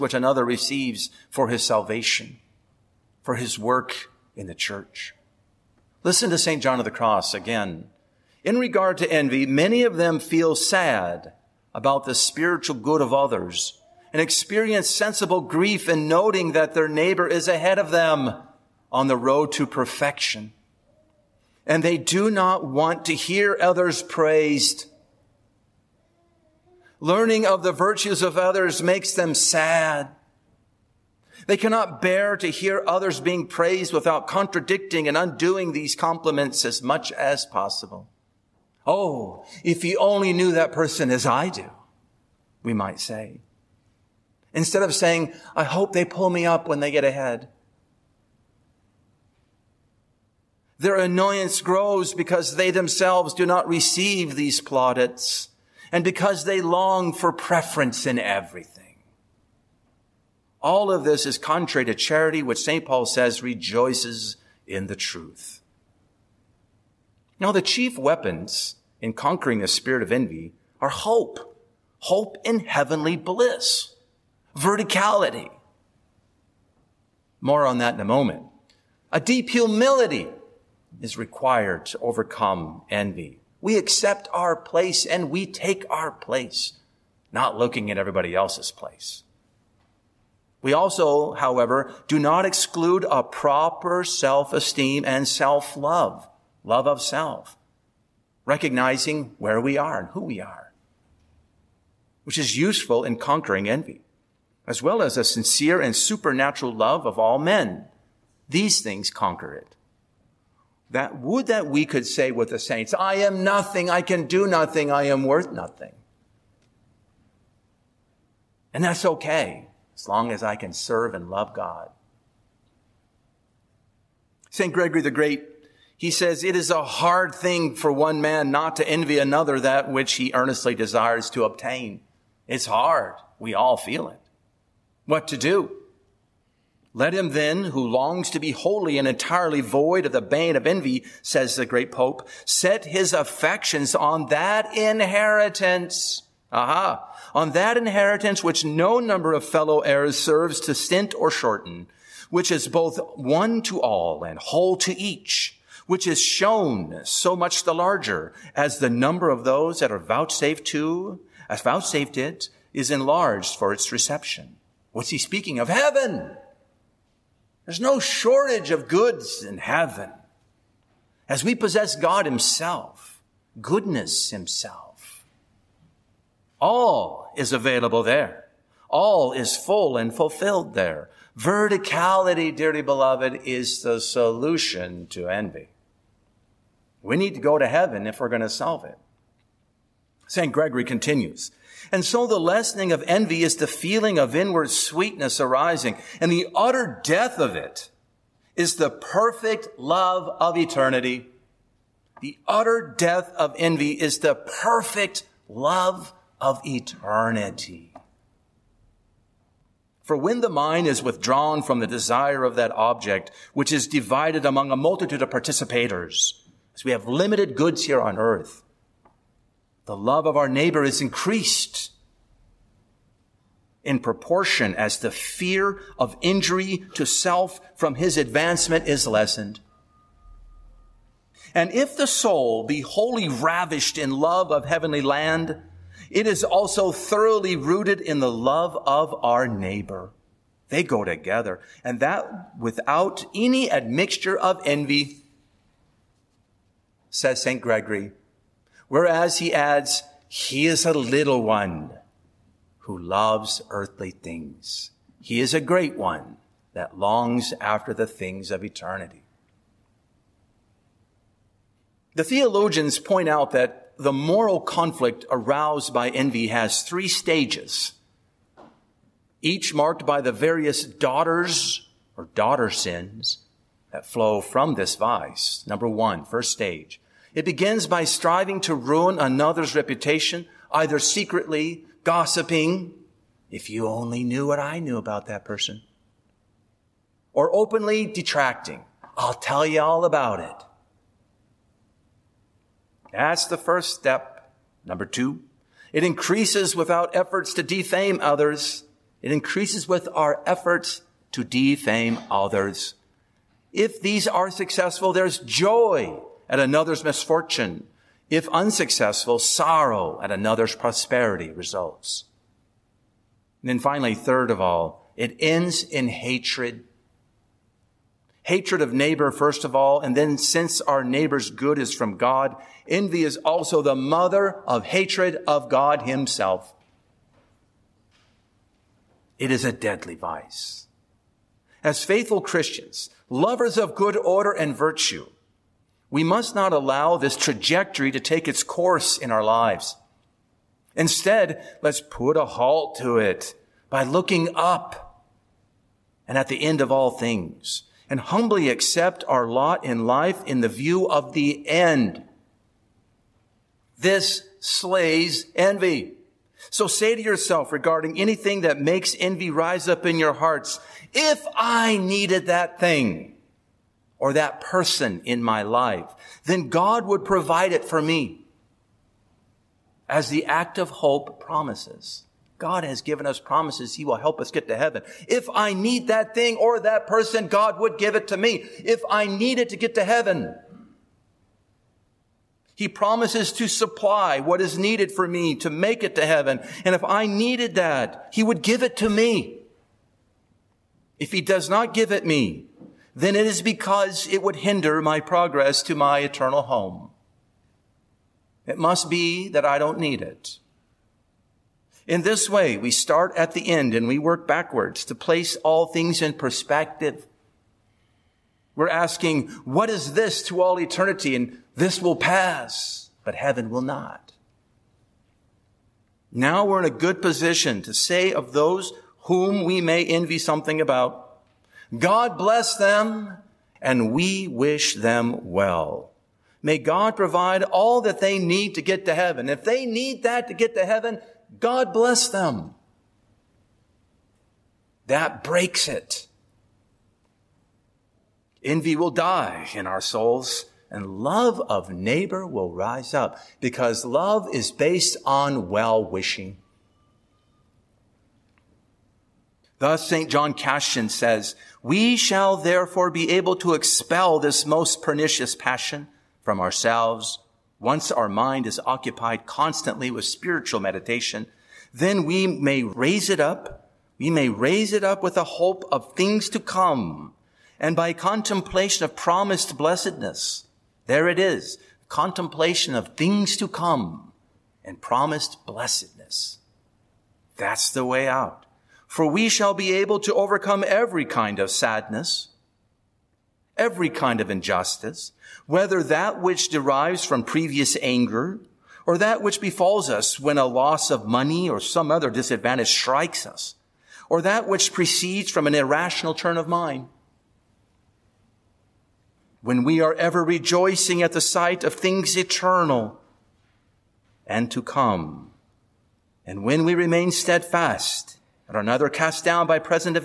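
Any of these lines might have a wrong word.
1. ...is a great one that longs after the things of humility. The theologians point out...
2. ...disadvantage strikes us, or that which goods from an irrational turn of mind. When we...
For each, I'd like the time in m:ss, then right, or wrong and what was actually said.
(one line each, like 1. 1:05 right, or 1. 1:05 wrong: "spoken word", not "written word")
1. 4:15 wrong: "eternity", not "humility"
2. 8:12 wrong: "proceeds", not "goods".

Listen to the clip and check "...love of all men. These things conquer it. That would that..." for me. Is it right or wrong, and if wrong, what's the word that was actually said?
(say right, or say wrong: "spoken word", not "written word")
right.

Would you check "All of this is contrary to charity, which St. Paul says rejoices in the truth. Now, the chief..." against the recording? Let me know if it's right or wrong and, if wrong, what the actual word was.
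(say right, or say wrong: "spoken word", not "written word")
right.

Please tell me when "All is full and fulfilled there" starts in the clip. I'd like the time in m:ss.
2:58.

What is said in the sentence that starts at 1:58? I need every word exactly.
And that's okay, as long as I can serve and love God.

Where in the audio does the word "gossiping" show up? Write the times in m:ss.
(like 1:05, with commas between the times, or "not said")
4:42.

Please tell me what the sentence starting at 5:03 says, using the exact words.
If these are successful, there's joy at another's misfortune.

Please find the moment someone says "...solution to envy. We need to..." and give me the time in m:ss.
3:03.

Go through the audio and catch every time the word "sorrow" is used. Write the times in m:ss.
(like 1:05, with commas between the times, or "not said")
5:09.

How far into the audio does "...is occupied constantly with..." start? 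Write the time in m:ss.
7:38.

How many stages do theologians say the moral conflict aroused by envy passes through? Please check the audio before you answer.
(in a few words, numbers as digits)
3.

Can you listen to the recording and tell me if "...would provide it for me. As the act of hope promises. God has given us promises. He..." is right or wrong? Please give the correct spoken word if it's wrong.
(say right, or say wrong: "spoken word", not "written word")
right.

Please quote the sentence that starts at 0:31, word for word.
They cannot bear to hear others being praised without contradicting and undoing these compliments as much as possible.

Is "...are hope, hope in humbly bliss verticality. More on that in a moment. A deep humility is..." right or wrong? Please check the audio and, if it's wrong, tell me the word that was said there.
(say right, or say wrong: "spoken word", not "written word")
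wrong: "heavenly", not "humbly".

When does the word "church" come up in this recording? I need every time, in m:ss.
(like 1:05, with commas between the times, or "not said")
0:04.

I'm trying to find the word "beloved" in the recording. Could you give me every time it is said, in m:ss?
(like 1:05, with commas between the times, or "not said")
3:02.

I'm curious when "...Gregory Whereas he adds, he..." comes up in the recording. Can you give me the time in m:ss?
4:07.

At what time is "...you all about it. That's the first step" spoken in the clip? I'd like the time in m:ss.
4:49.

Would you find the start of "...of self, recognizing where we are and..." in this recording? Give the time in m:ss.
1:36.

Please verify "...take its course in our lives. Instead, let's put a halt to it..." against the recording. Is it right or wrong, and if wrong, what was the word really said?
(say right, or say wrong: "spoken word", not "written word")
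right.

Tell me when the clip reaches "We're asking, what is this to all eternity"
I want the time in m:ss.
6:48.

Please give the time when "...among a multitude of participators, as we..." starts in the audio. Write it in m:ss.
3:34.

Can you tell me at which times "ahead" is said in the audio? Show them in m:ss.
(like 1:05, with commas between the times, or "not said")
0:17, 0:47.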